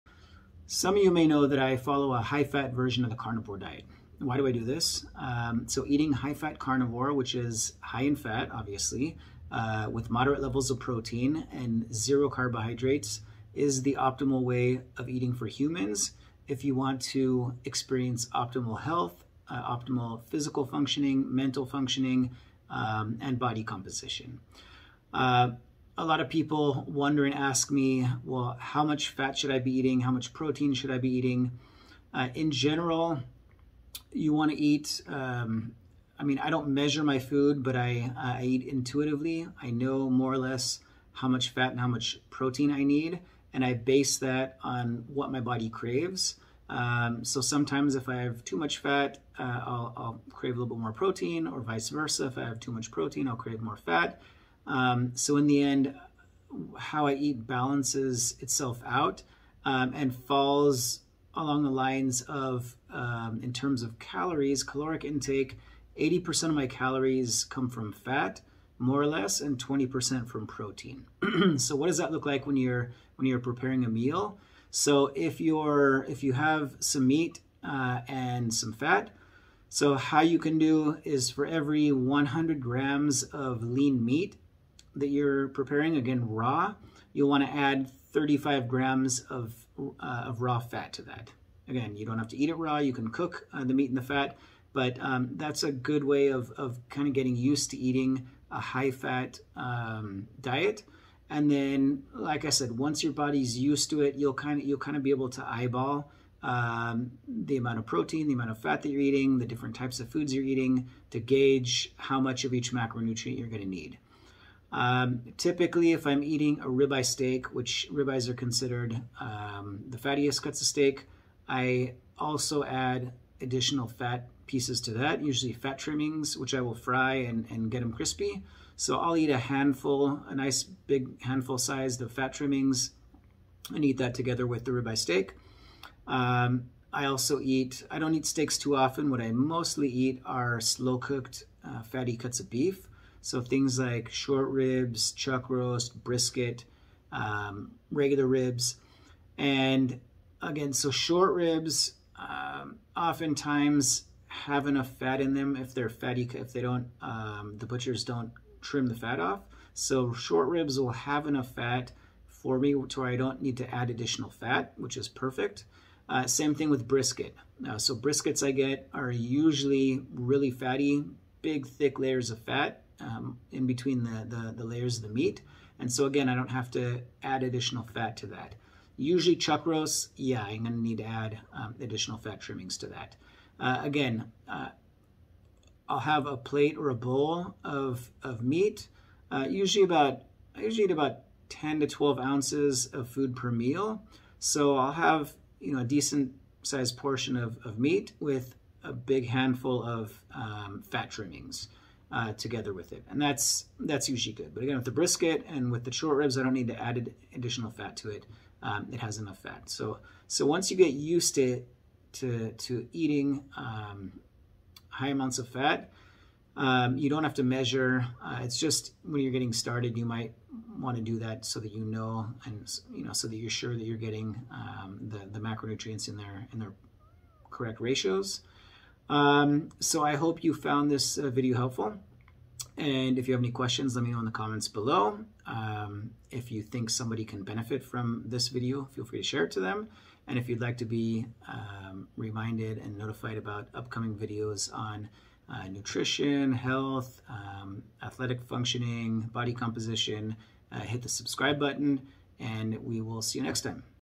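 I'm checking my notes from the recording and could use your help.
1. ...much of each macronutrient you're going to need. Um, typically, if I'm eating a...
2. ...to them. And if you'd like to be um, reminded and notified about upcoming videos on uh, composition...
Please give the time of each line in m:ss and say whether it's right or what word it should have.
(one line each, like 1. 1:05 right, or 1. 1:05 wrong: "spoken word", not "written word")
1. 1:52 right
2. 3:59 wrong: "nutrition", not "composition".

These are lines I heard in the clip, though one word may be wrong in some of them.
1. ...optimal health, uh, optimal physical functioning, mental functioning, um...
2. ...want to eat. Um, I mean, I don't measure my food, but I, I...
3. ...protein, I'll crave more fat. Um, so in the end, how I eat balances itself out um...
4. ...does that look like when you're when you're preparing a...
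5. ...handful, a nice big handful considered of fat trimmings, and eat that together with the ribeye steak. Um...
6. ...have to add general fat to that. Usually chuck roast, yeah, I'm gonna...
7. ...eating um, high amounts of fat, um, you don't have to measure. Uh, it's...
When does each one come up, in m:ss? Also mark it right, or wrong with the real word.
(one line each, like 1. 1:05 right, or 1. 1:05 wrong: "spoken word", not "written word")
1. 0:18 right
2. 0:34 right
3. 0:52 right
4. 1:11 right
5. 2:09 wrong: "sized", not "considered"
6. 2:56 wrong: "additional", not "general"
7. 3:32 right.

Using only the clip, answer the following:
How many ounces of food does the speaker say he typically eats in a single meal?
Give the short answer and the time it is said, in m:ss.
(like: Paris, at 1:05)
10 to 12 ounces, at 3:11.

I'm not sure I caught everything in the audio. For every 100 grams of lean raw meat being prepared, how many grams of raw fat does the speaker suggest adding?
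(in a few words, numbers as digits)
35 grams.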